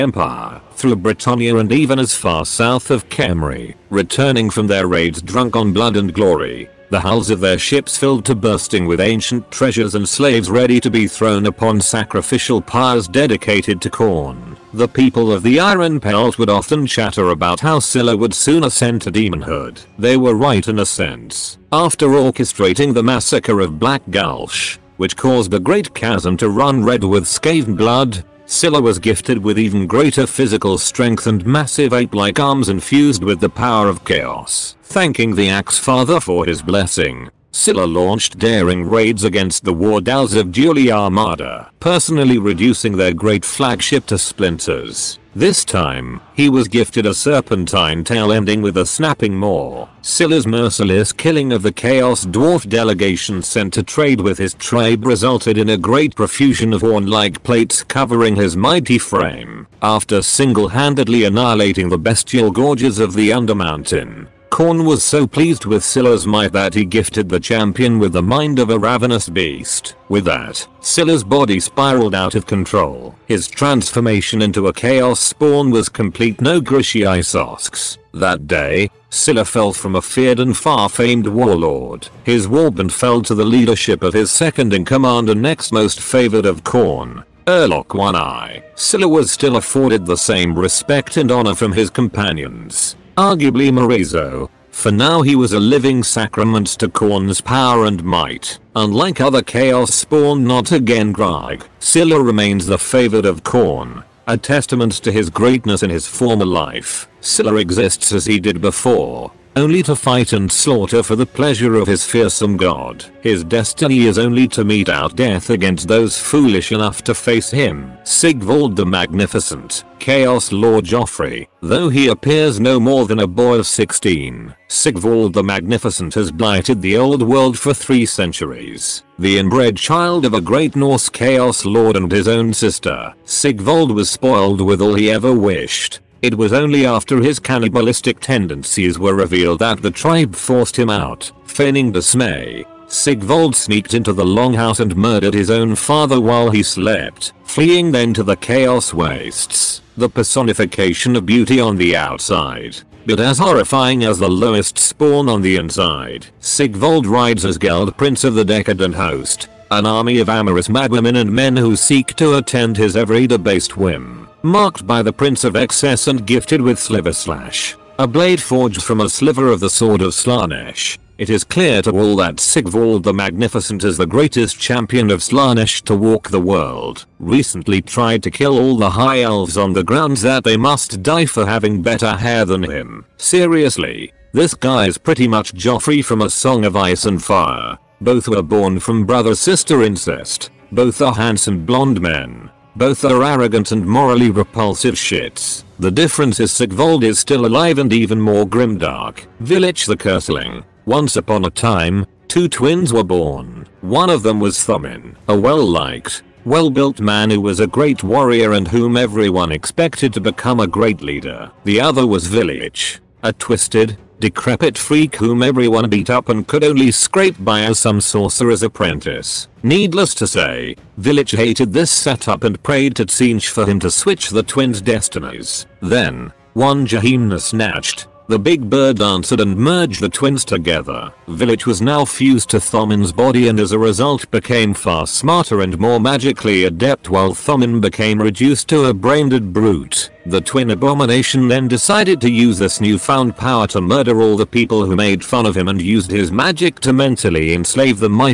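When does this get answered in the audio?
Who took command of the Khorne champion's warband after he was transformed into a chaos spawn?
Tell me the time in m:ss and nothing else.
1:27.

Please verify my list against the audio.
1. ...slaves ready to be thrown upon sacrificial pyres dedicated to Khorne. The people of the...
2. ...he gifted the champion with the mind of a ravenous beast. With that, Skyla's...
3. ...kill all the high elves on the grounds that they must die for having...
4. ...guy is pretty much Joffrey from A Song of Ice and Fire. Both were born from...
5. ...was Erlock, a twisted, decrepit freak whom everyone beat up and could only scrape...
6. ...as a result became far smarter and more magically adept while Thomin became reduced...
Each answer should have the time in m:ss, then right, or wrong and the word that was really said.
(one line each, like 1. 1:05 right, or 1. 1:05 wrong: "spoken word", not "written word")
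1. 0:10 right
2. 1:06 right
3. 2:58 right
4. 3:04 right
5. 3:32 wrong: "Vilitch", not "Erlock"
6. 3:53 right.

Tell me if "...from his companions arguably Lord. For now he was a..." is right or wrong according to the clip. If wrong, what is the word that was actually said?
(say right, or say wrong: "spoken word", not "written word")
wrong: "Morezo", not "Lord".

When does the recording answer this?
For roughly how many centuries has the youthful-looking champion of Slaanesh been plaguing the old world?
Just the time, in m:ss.
2:07.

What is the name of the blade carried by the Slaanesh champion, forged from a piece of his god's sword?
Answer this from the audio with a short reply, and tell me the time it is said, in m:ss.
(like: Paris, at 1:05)
Sliver Slash, at 2:46.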